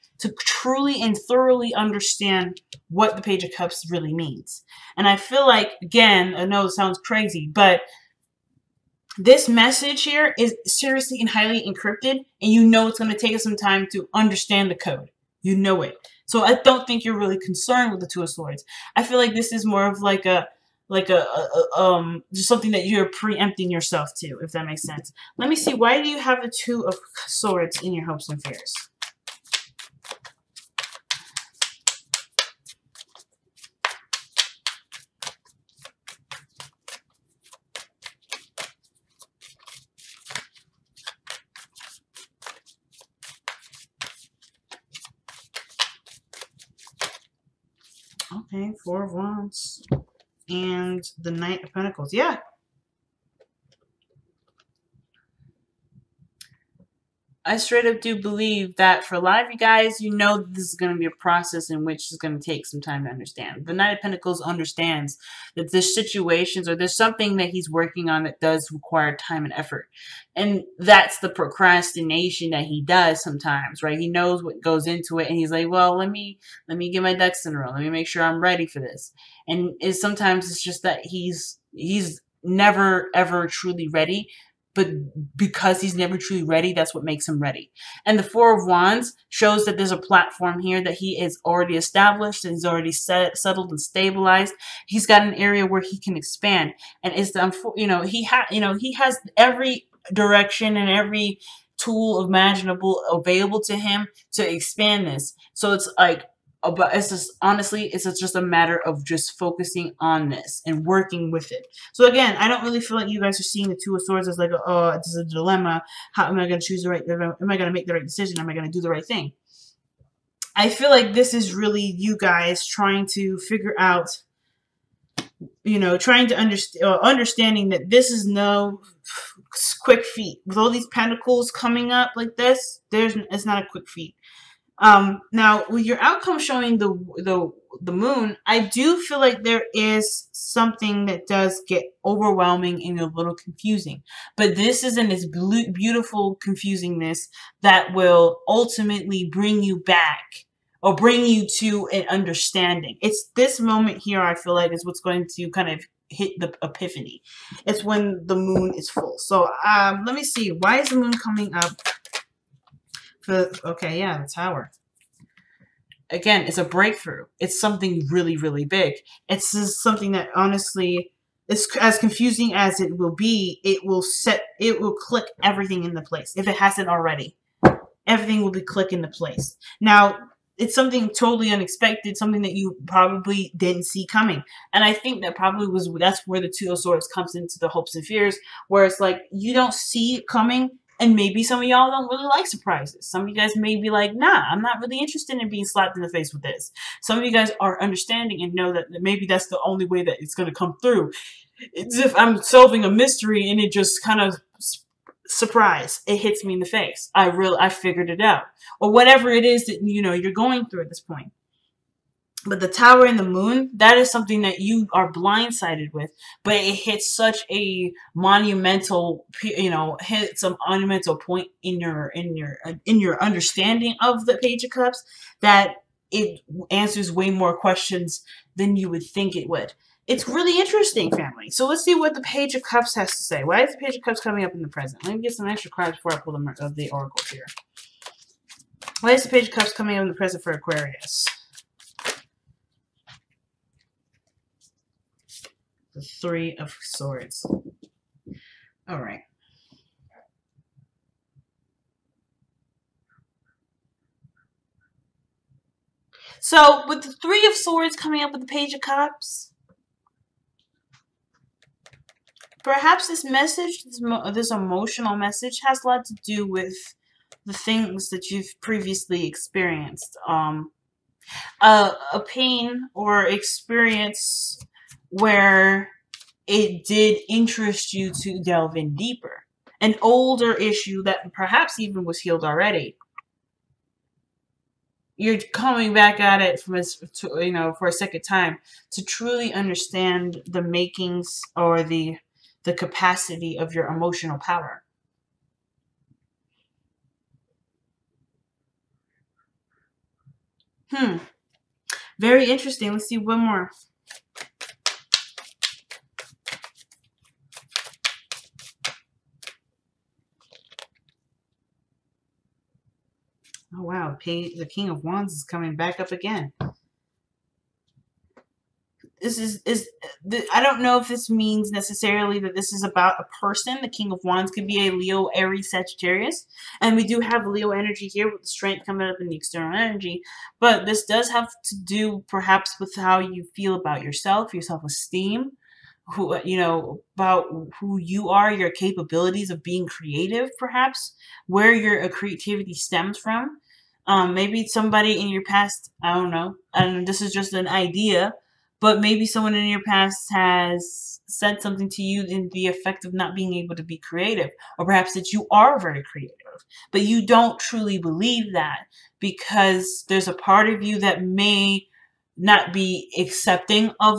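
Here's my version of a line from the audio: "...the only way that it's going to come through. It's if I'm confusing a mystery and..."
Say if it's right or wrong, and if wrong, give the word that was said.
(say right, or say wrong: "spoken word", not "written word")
wrong: "solving", not "confusing".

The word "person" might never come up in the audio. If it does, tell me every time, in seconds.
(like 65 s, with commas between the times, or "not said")
323 s.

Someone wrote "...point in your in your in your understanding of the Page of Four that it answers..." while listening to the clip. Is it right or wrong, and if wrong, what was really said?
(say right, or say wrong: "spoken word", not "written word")
wrong: "Cups", not "Four".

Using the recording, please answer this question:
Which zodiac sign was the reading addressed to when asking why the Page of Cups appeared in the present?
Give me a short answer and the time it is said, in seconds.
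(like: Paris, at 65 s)
Aquarius, at 240 s.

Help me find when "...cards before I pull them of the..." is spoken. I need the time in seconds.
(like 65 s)
235 s.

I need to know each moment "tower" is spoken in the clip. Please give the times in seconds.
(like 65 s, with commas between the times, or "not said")
164 s, 212 s.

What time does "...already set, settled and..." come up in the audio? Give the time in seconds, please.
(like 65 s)
92 s.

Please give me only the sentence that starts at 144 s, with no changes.
But this isn't this beautiful confusingness that will ultimately bring you back or bring you to an understanding.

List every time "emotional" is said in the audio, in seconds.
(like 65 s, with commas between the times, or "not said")
264 s, 293 s.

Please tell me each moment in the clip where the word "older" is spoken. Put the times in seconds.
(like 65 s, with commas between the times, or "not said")
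280 s.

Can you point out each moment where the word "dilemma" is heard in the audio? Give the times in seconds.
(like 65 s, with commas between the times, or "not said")
115 s.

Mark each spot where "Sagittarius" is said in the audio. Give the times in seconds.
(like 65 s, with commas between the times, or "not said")
325 s.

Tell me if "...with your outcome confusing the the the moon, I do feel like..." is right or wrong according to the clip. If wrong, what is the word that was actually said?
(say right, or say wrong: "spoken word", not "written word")
wrong: "showing", not "confusing".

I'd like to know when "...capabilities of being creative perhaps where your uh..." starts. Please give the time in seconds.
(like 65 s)
338 s.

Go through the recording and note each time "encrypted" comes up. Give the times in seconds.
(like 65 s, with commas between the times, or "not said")
11 s.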